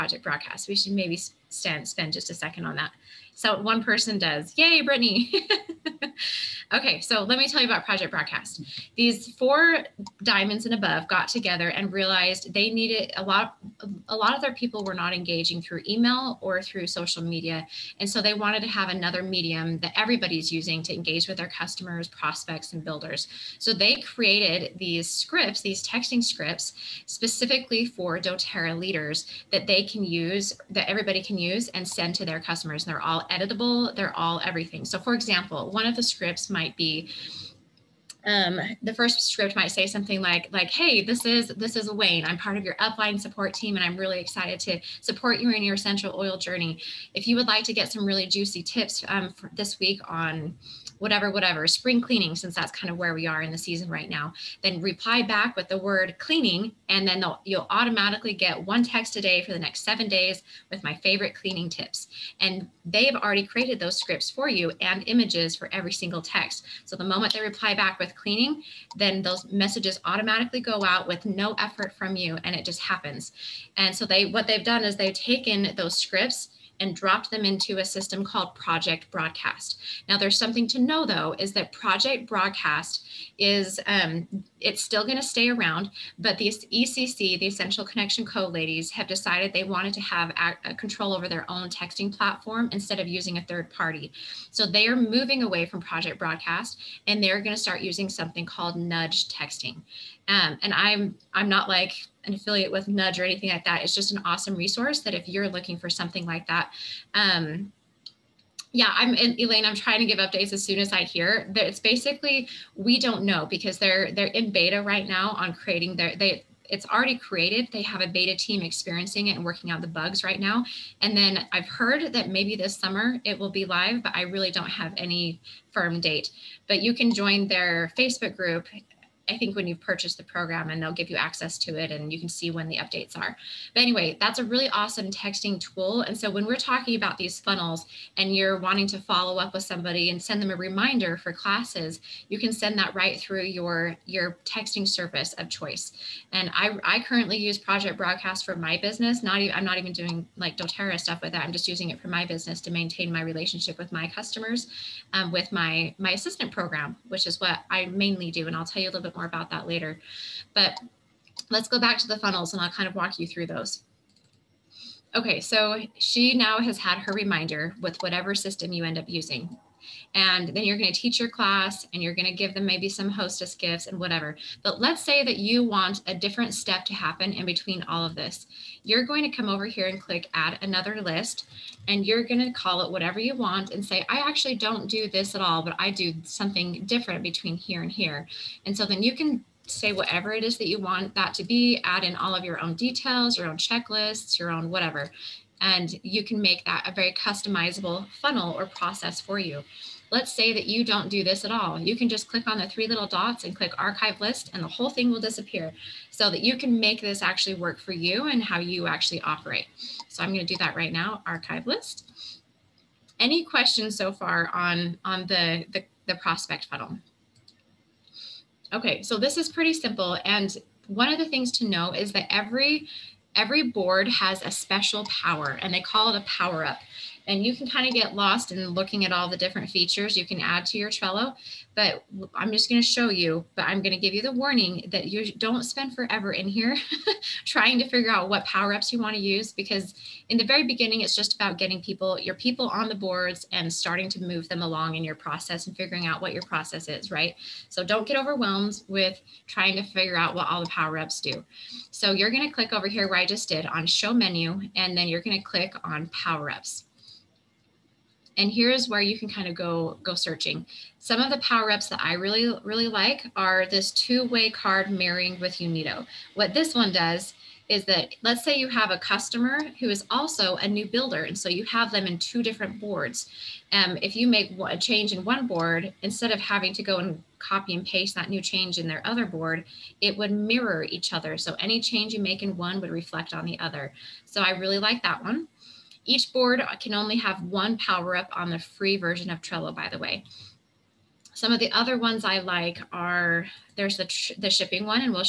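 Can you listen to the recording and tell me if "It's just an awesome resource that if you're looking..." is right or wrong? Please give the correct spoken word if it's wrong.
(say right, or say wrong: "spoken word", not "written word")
right.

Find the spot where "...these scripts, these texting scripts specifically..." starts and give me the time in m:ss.
0:24.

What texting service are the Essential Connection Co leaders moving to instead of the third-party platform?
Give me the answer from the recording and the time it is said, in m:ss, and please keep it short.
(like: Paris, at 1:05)
Nudge Texting, at 1:38.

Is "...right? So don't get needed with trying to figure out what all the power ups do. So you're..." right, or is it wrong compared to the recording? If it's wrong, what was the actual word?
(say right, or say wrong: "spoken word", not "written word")
wrong: "overwhelmed", not "needed".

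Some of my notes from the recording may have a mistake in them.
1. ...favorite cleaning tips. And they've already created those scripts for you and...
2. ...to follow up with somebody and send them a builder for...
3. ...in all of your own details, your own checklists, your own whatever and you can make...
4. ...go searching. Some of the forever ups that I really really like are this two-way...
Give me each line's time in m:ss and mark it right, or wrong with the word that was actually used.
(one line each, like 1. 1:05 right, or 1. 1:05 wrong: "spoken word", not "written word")
1. 1:00 right
2. 2:18 wrong: "reminder", not "builder"
3. 3:12 right
4. 4:20 wrong: "power", not "forever".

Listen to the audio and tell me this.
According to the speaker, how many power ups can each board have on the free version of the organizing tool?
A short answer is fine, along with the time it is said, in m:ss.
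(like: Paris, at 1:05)
1, at 4:47.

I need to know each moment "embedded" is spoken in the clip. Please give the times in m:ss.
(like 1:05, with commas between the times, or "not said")
not said.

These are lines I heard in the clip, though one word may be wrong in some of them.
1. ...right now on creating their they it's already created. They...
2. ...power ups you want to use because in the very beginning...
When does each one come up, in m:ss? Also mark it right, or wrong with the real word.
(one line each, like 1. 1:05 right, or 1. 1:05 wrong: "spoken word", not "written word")
1. 1:54 right
2. 3:58 right.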